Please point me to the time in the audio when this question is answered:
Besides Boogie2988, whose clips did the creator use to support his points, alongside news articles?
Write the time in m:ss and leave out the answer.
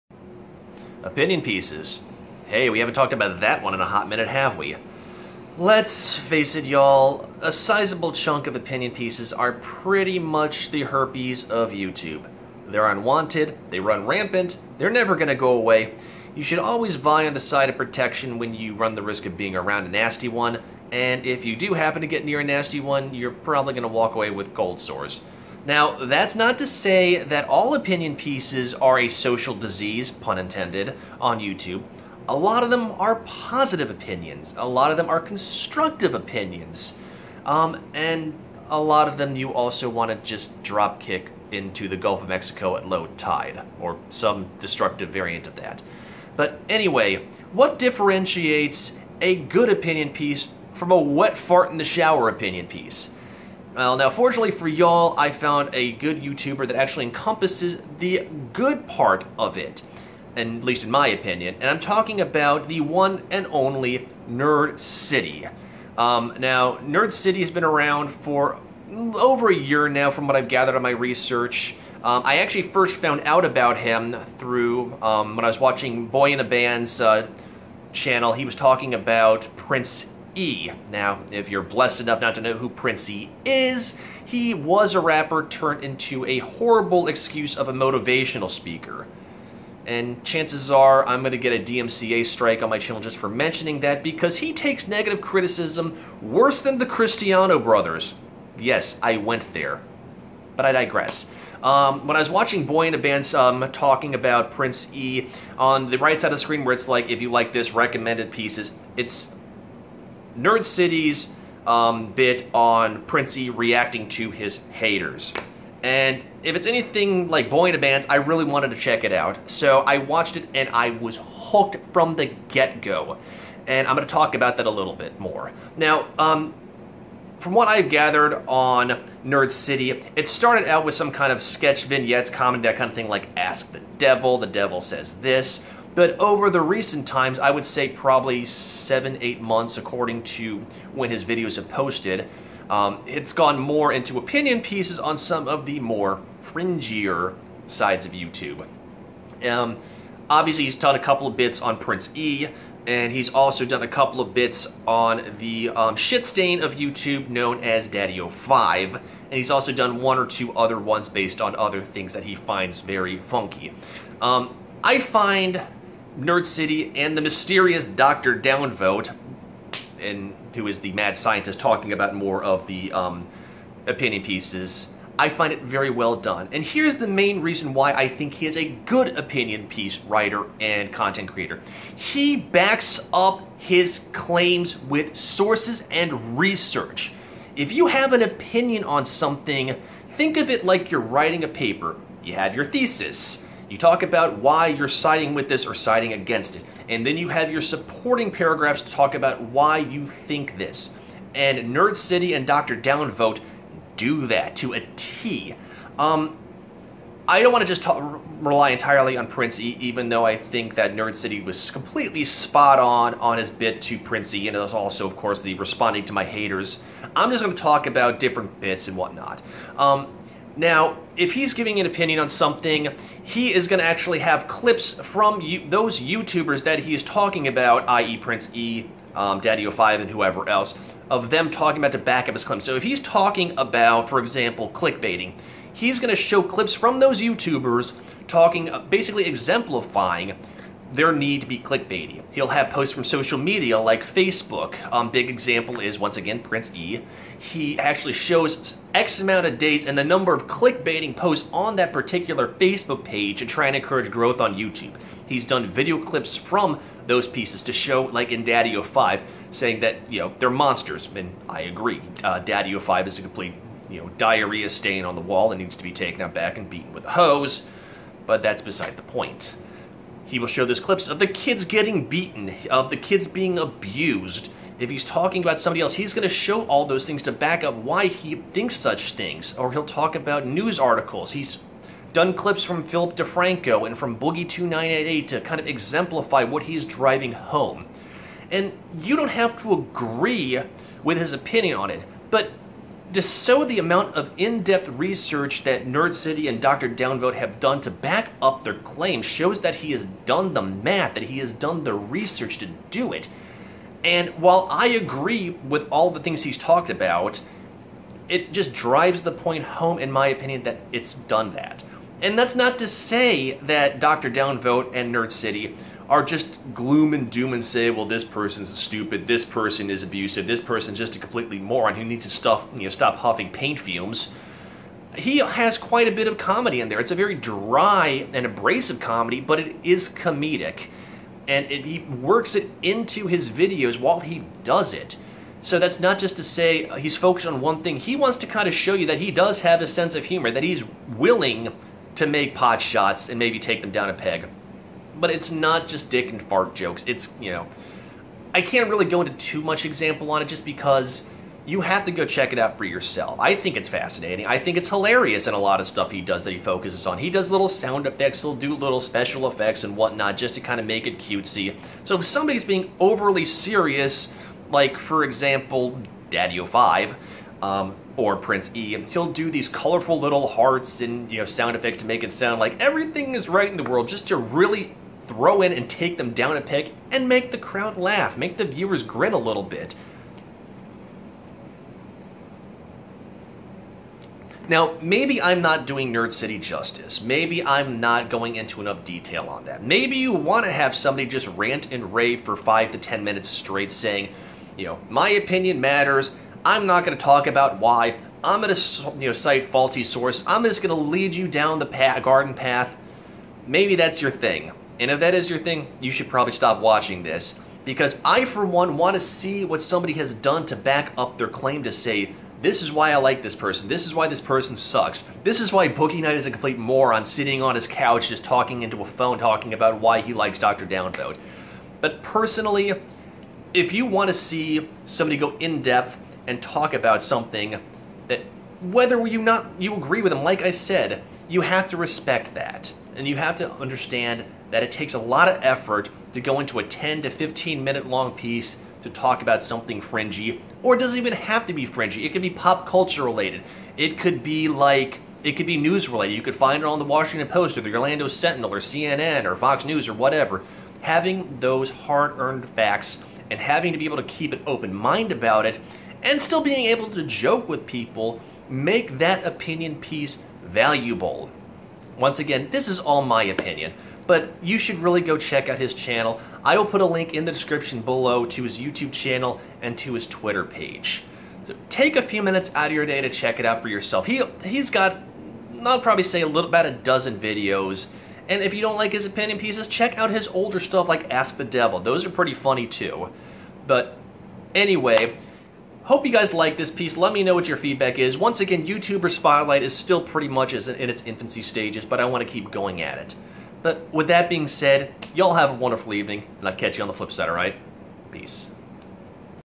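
4:42.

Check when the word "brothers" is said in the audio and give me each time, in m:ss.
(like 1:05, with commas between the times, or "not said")
1:37.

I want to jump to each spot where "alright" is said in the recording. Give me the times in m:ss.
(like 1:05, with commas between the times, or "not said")
8:17.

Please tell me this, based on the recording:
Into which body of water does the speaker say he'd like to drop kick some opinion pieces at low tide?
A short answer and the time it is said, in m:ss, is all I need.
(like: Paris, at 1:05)
Gulf of Mexico, at 0:41.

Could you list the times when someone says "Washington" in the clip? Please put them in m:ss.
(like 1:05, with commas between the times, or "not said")
7:27.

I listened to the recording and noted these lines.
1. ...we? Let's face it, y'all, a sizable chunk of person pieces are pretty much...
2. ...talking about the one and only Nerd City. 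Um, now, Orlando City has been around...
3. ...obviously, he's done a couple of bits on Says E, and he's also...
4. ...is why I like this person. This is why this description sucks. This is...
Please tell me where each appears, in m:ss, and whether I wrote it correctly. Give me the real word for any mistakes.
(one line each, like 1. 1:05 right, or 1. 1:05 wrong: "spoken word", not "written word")
1. 0:04 wrong: "opinion", not "person"
2. 1:01 wrong: "Nerd", not "Orlando"
3. 2:30 wrong: "Prince", not "Says"
4. 6:52 wrong: "person", not "description".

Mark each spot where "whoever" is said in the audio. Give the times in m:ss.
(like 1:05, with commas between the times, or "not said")
3:50.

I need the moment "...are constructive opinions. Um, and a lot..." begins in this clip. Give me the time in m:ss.
0:35.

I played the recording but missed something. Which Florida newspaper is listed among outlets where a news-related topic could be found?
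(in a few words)
Orlando Sentinel.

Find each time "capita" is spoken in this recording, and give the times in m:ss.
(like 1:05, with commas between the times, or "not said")
not said.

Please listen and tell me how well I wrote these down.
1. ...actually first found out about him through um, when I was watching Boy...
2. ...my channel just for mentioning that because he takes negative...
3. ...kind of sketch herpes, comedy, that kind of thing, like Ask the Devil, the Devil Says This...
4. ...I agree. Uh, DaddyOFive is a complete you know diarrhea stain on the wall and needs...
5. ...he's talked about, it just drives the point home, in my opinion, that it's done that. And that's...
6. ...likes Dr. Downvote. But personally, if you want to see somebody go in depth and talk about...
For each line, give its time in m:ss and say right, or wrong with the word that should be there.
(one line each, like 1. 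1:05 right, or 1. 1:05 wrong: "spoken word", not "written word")
1. 1:12 right
2. 1:32 right
3. 2:11 wrong: "vignettes", not "herpes"
4. 4:21 right
5. 5:06 right
6. 7:00 right.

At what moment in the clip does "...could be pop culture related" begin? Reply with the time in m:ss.
7:22.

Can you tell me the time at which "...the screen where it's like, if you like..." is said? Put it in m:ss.
1:46.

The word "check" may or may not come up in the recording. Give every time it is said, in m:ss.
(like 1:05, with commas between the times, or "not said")
1:58, 5:52, 7:45, 7:53, 7:59.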